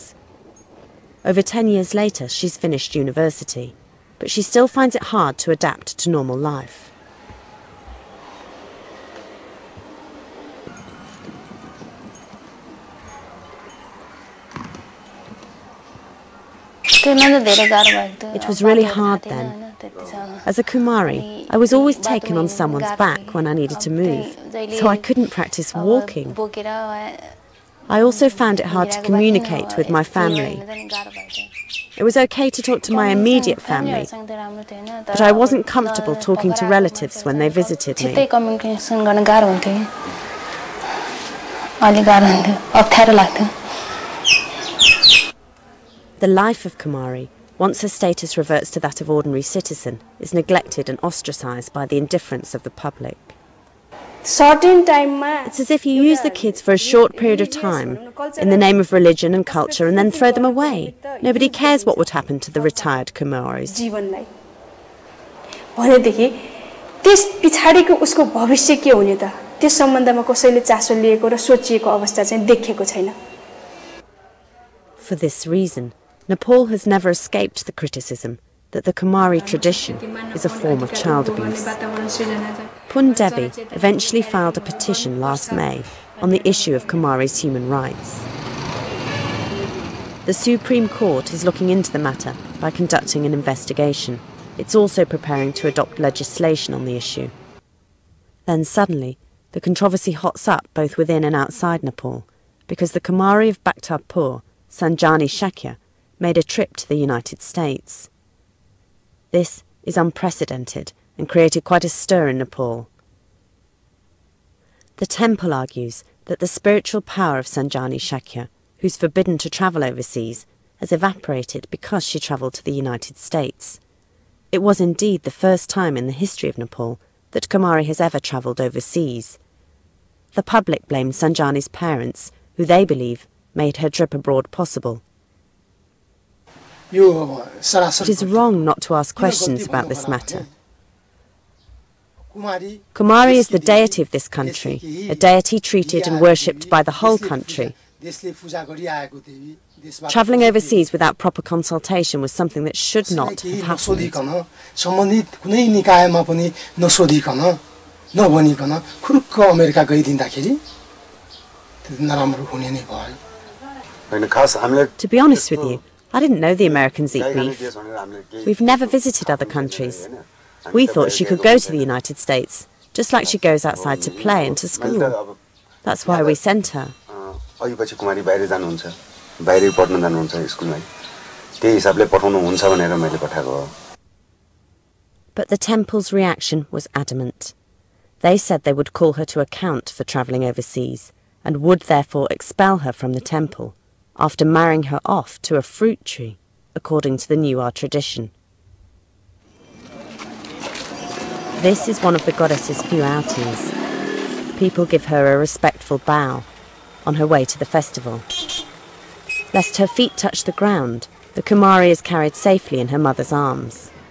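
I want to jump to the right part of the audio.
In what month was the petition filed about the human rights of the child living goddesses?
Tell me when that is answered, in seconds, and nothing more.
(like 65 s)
85 s.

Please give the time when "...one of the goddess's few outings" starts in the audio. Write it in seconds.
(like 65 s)
202 s.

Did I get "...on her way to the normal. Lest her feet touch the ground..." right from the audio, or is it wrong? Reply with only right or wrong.
wrong.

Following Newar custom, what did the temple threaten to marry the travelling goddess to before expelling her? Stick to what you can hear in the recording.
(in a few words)
a fruit tree.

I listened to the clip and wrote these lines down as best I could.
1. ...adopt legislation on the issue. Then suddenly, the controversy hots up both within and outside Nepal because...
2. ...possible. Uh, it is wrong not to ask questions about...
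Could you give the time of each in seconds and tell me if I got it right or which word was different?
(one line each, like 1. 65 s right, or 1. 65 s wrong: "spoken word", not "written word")
1. 95 s right
2. 134 s right.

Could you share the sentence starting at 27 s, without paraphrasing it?
I also found it hard to communicate with my family.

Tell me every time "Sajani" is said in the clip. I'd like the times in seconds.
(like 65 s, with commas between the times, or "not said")
104 s, 117 s, 131 s.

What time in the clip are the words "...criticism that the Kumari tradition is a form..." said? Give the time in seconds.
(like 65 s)
77 s.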